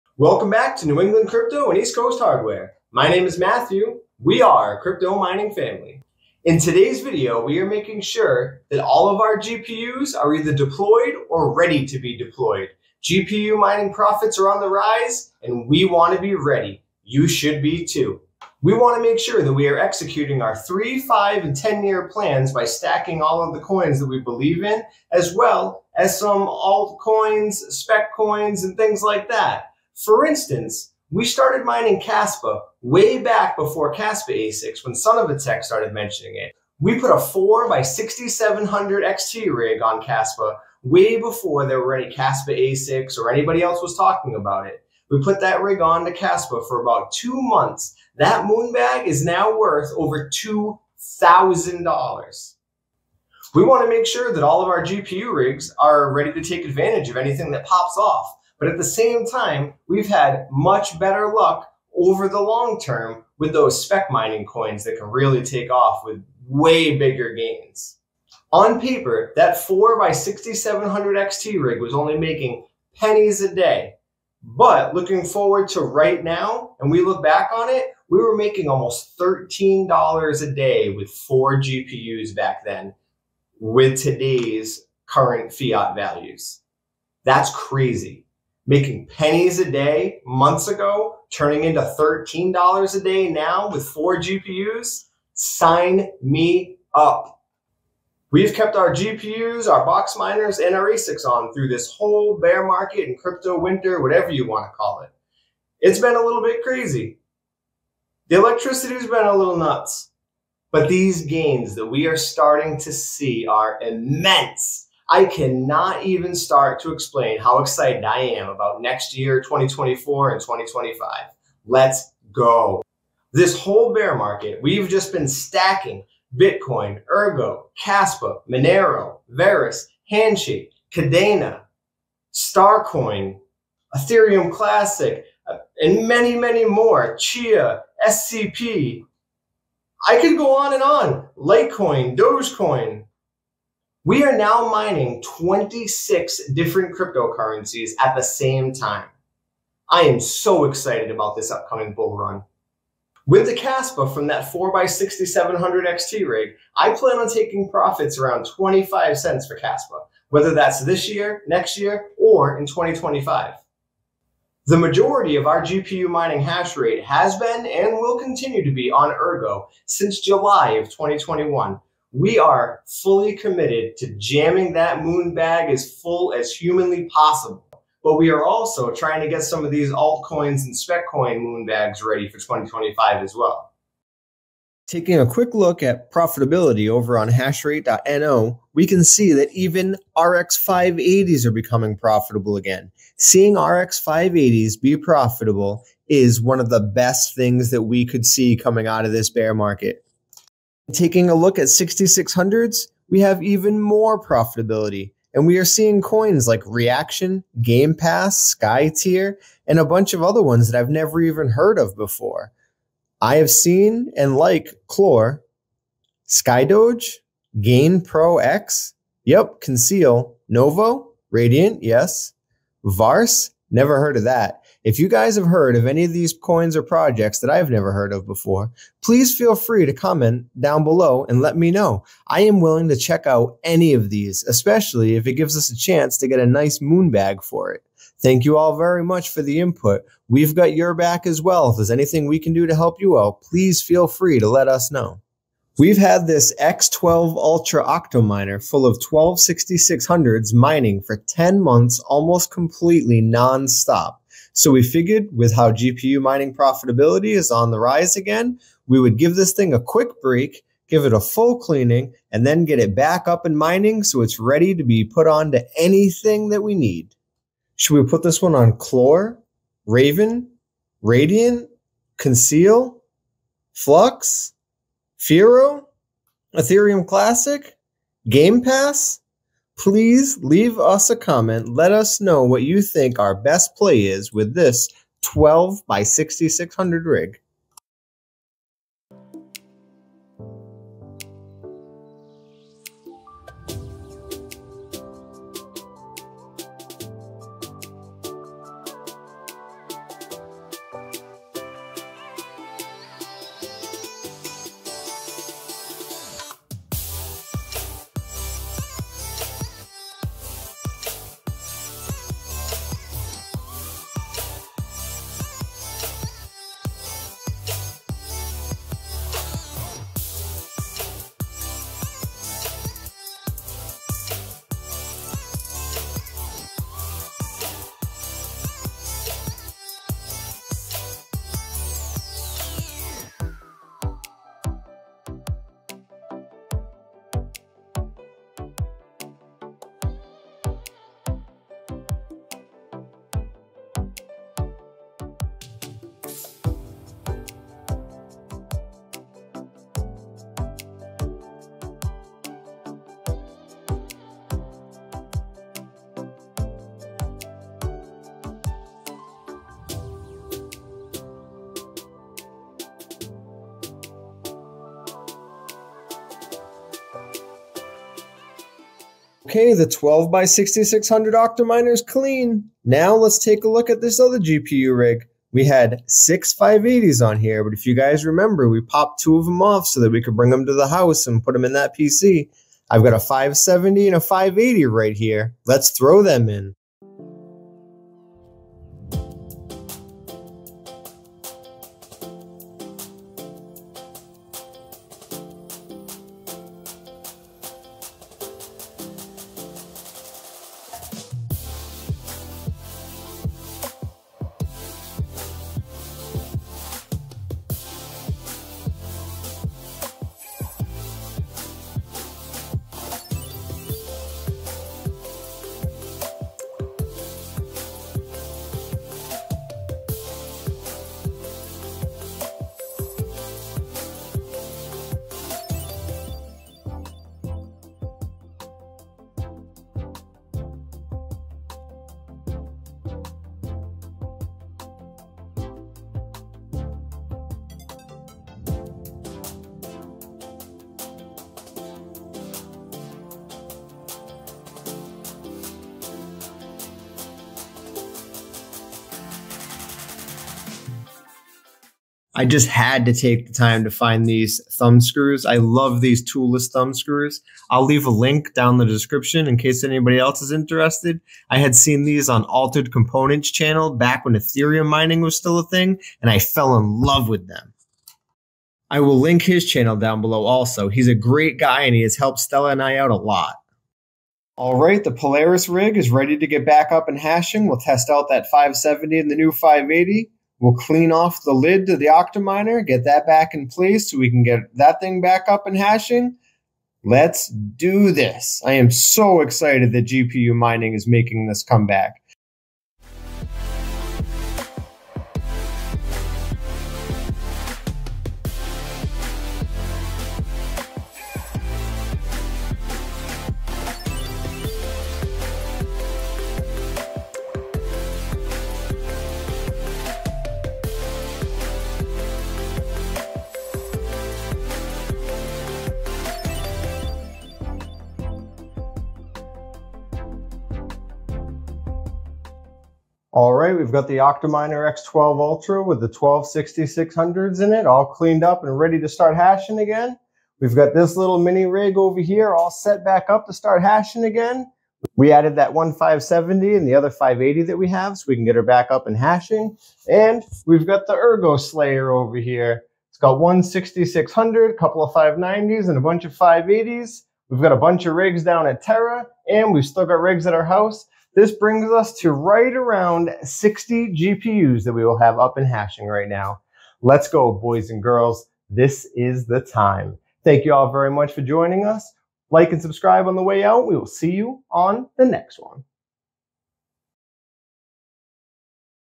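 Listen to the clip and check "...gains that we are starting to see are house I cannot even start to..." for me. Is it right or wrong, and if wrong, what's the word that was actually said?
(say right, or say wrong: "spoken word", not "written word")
wrong: "immense", not "house".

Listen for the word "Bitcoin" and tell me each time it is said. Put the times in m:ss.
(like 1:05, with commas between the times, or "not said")
2:06.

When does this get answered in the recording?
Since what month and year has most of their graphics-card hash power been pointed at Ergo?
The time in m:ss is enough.
2:50.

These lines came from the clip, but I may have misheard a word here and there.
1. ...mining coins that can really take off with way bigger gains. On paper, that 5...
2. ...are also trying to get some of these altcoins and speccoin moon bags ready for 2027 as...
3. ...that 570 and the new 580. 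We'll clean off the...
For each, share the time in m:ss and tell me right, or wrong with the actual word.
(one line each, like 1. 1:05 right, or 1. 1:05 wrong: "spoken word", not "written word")
1. 1:04 wrong: "4", not "5"
2. 2:58 wrong: "2025", not "2027"
3. 7:58 right.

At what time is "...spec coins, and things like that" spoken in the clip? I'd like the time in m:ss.
0:27.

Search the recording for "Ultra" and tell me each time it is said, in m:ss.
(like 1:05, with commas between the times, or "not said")
4:07, 8:45.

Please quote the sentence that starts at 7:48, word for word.
I will link his channel down below also.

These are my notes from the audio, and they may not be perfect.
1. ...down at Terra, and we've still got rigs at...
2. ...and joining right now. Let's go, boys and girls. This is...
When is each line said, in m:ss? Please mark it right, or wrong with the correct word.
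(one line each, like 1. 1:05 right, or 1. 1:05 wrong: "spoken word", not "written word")
1. 9:08 right
2. 9:15 wrong: "hashing", not "joining".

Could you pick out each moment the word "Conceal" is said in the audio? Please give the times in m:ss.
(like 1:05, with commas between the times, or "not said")
3:39, 4:32.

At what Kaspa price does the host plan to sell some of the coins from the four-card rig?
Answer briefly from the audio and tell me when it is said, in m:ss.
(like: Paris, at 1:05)
25 cents, at 2:38.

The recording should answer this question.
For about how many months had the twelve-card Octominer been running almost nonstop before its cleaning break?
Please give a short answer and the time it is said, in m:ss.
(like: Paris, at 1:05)
10, at 4:11.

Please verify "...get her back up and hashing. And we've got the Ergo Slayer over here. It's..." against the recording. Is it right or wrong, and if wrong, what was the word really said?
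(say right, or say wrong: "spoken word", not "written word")
right.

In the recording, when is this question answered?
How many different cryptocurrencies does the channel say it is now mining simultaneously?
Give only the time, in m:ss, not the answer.
2:25.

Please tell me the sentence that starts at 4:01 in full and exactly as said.
If there's anything we can do to help you out, please feel free to let us know.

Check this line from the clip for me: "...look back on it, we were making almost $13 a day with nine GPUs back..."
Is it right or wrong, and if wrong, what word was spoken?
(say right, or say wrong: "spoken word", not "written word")
wrong: "four", not "nine".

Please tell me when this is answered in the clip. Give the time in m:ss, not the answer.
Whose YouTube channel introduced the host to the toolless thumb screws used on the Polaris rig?
7:42.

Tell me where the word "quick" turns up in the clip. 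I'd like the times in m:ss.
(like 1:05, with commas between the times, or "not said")
3:05, 4:19.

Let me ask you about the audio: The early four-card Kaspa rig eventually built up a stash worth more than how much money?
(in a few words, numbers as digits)
$2,000.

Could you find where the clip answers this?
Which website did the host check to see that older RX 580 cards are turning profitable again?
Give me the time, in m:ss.
3:07.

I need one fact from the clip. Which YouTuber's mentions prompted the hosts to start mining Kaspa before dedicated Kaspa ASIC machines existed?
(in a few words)
Son of a Tech.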